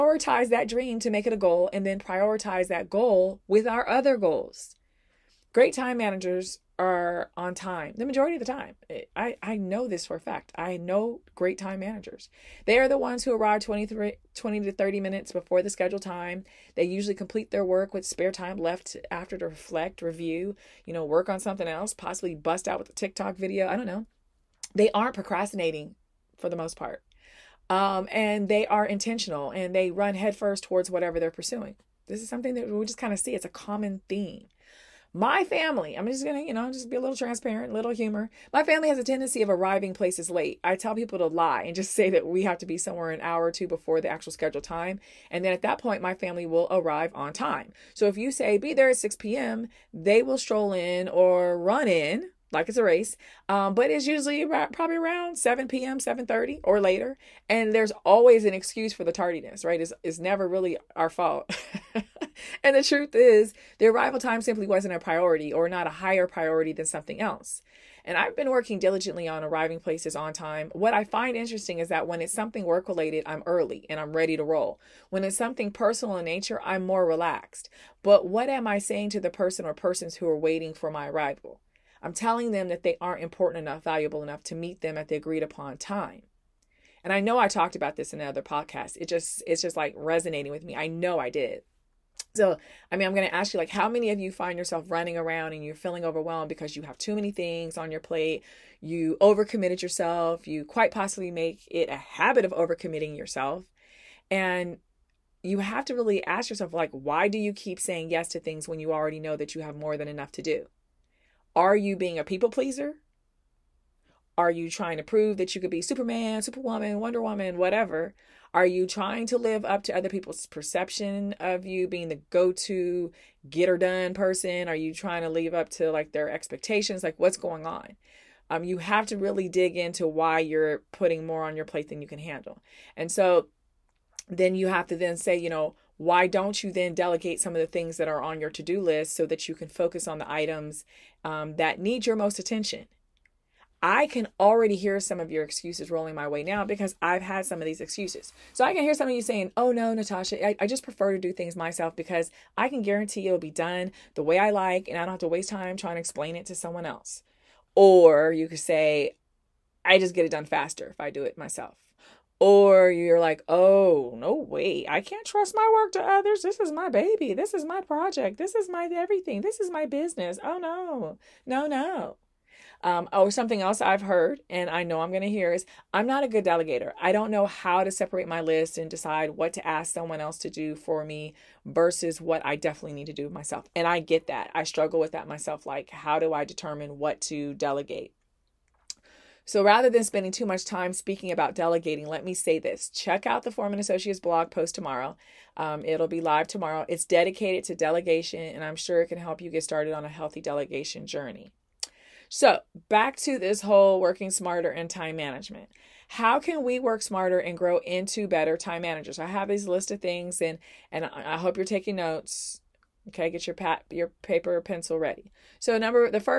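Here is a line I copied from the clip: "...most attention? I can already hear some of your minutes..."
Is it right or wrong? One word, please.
wrong.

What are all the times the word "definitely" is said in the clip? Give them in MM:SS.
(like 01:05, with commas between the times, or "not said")
03:02.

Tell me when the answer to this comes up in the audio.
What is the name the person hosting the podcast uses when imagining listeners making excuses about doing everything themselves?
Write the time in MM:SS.
02:29.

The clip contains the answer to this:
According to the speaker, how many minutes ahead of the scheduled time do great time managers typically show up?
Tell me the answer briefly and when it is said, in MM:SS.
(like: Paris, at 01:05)
20 to 30 minutes, at 00:14.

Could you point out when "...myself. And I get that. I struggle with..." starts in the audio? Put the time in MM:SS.
03:03.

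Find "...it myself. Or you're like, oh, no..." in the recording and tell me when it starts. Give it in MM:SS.
02:41.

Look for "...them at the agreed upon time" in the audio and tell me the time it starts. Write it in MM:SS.
01:24.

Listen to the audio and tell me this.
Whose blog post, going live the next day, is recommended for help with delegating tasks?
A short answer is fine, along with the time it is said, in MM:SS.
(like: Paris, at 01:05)
Foreman Associates, at 03:13.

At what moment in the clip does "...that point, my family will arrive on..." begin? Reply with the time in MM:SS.
00:45.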